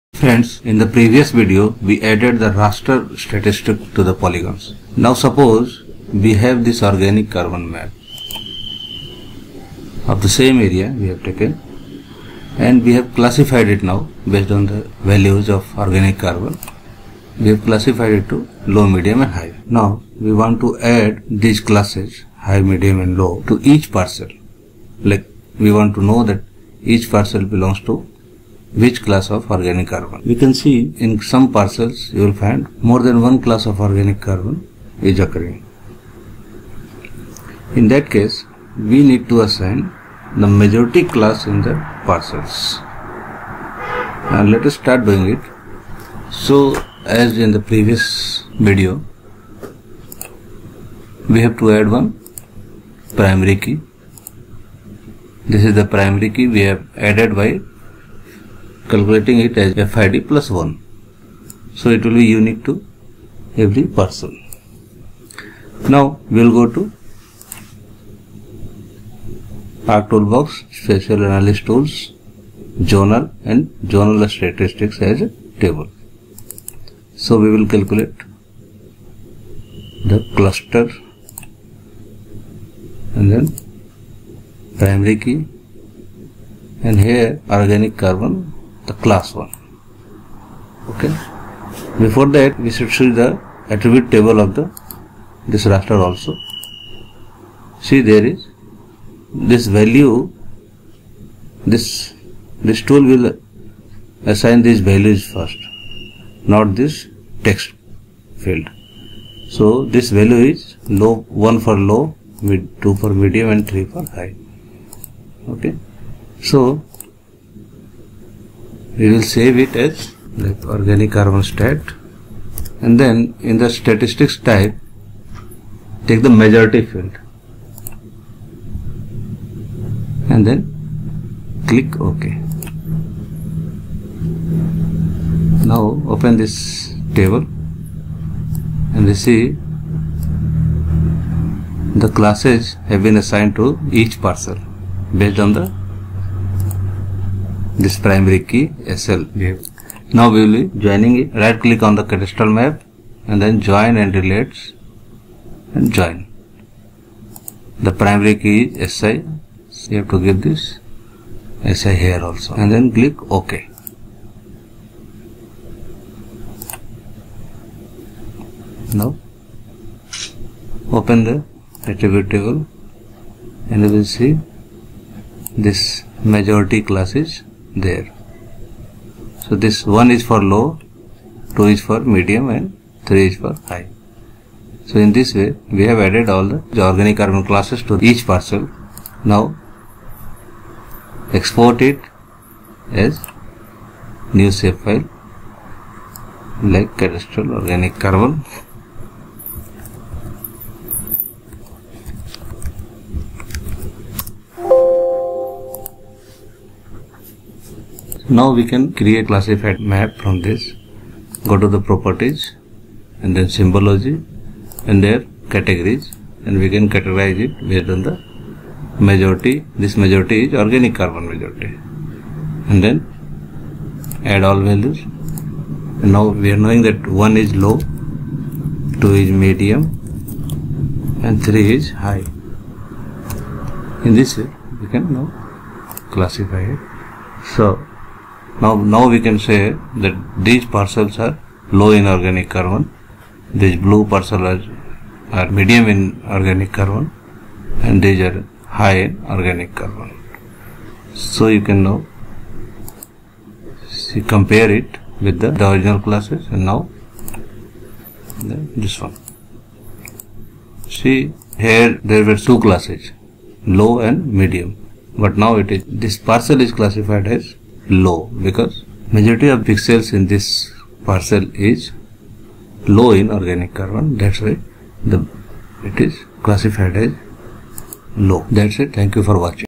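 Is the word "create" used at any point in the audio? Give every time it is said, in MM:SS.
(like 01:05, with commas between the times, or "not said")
03:28.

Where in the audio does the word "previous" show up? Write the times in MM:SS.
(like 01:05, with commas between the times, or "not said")
00:00, 00:47.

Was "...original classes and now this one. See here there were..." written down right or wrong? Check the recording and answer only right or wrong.
right.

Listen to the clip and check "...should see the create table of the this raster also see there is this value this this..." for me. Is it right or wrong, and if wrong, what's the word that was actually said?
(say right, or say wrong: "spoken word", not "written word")
wrong: "attribute", not "create".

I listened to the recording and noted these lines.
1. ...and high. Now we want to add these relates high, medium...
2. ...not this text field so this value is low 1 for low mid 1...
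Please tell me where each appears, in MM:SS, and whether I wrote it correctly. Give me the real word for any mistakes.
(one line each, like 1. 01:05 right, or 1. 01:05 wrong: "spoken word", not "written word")
1. 00:19 wrong: "classes", not "relates"
2. 01:46 wrong: "2", not "1".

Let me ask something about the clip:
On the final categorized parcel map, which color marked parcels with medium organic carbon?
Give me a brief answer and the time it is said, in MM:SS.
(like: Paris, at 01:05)
blue, at 04:03.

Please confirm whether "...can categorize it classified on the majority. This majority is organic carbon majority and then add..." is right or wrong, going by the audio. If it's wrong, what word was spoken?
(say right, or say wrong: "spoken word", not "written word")
wrong: "based", not "classified".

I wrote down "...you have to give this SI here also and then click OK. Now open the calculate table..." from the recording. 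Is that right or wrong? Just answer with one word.
wrong.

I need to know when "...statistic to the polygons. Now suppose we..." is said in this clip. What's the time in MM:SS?
00:03.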